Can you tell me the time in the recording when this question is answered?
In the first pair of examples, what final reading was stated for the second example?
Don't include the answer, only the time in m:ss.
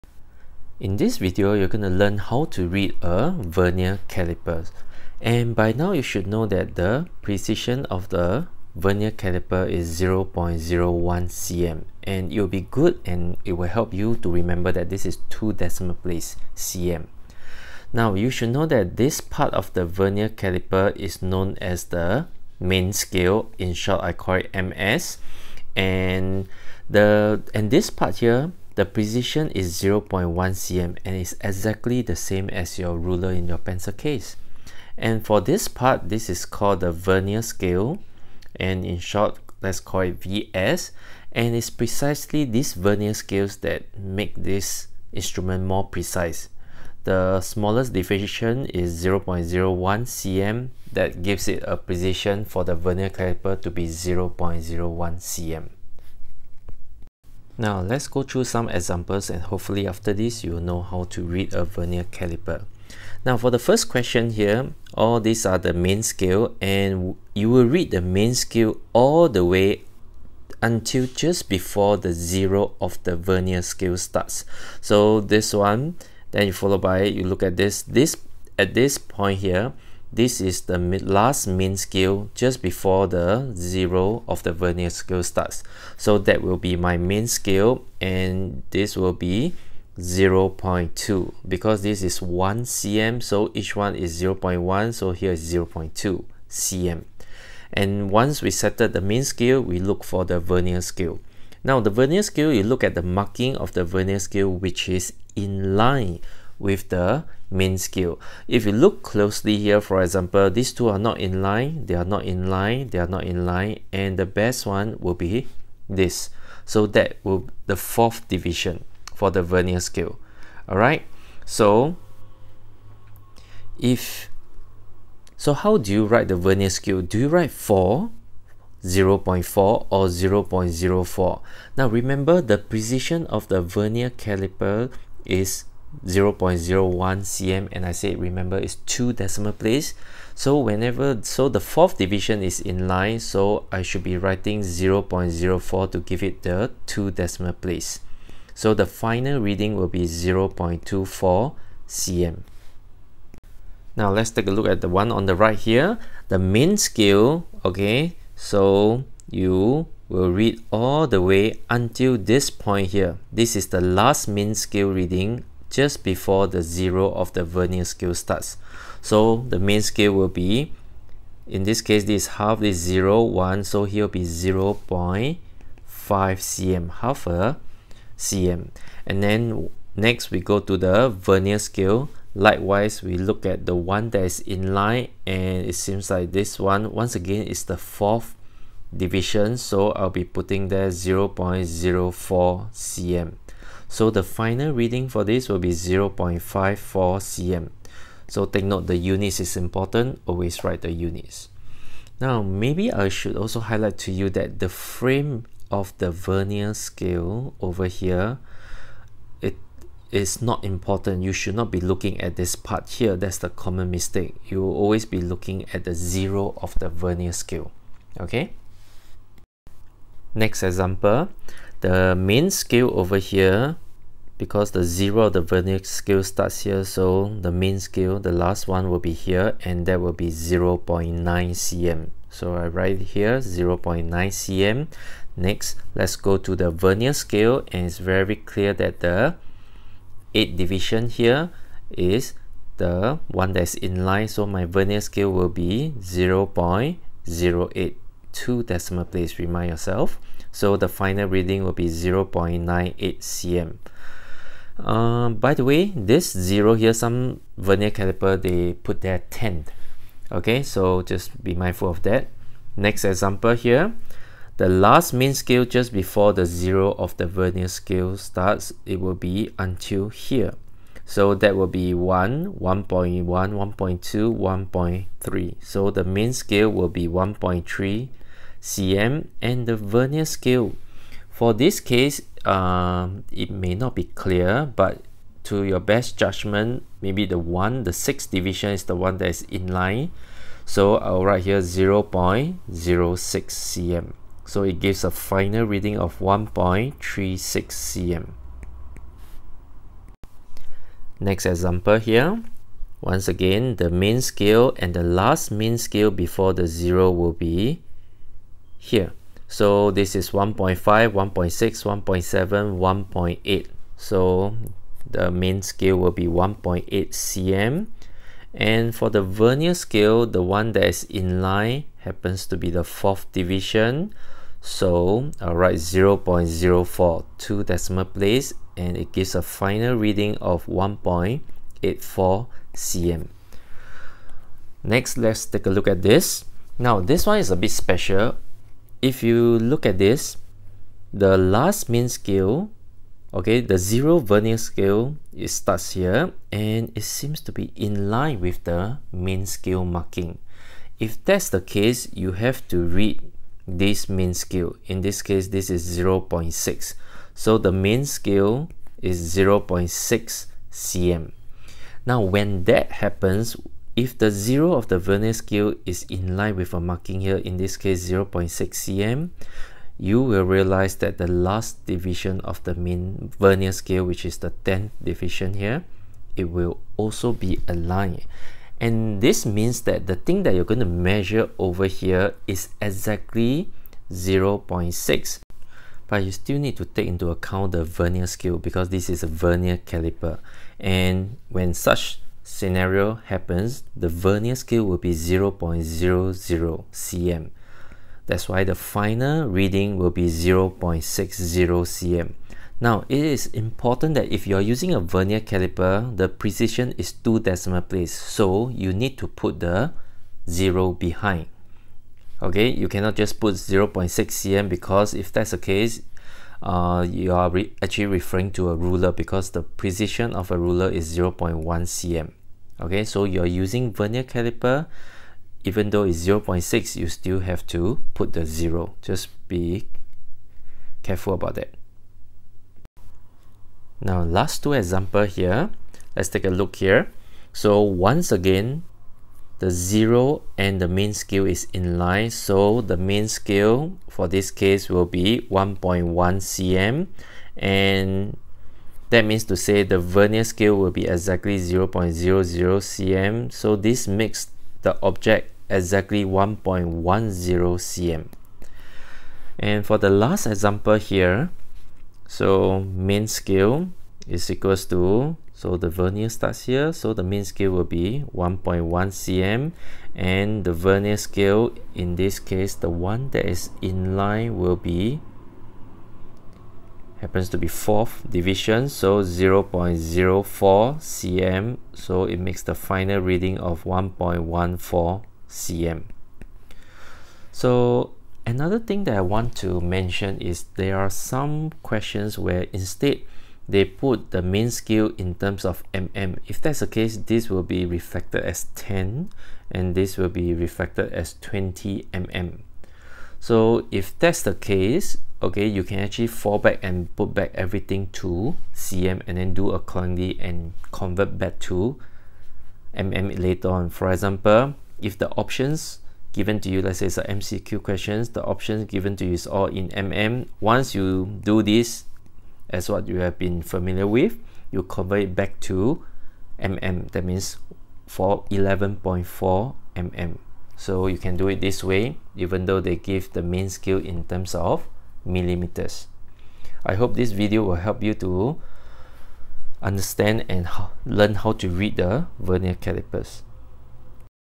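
3:15.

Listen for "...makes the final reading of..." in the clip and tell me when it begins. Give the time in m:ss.
8:02.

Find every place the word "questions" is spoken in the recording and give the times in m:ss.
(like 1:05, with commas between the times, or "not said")
1:03, 8:11, 8:37.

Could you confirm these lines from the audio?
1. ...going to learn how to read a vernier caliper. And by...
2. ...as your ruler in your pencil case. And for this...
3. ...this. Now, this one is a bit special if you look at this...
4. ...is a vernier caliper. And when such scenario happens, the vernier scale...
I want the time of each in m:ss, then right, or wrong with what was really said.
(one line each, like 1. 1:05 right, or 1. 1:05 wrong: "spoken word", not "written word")
1. 0:01 right
2. 0:32 right
3. 5:36 right
4. 6:29 right.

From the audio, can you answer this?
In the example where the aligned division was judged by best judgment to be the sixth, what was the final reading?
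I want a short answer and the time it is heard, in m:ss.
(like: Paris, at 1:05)
1.36 cm, at 4:56.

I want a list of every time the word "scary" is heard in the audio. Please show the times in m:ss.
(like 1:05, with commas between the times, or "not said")
not said.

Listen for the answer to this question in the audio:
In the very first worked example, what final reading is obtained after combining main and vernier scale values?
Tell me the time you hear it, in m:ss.
2:30.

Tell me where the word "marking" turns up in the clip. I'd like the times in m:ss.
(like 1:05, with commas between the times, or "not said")
1:43, 5:49, 6:06.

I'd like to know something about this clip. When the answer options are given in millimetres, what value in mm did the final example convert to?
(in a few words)
11.4 mm.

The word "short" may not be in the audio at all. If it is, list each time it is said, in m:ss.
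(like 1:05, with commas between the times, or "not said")
0:23, 0:38.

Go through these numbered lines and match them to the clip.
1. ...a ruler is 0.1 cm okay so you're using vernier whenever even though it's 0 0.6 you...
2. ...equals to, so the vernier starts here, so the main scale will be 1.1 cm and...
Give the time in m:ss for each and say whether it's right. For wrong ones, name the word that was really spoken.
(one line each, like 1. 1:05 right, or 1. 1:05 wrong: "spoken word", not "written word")
1. 7:00 wrong: "caliper", not "whenever"
2. 7:44 right.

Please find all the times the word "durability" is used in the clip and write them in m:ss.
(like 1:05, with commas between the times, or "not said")
not said.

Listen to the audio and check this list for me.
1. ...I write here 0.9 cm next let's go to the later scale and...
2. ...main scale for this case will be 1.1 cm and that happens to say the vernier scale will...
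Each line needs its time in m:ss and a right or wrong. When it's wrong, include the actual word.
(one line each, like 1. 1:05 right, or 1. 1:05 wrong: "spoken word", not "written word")
1. 3:52 wrong: "vernier", not "later"
2. 7:22 wrong: "means", not "happens".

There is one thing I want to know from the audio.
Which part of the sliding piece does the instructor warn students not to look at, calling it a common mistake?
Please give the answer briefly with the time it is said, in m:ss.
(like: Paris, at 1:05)
the frame, at 3:24.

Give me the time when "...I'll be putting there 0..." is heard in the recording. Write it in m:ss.
3:09.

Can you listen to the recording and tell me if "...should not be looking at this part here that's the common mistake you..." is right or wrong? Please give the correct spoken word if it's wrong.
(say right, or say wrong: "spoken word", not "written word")
right.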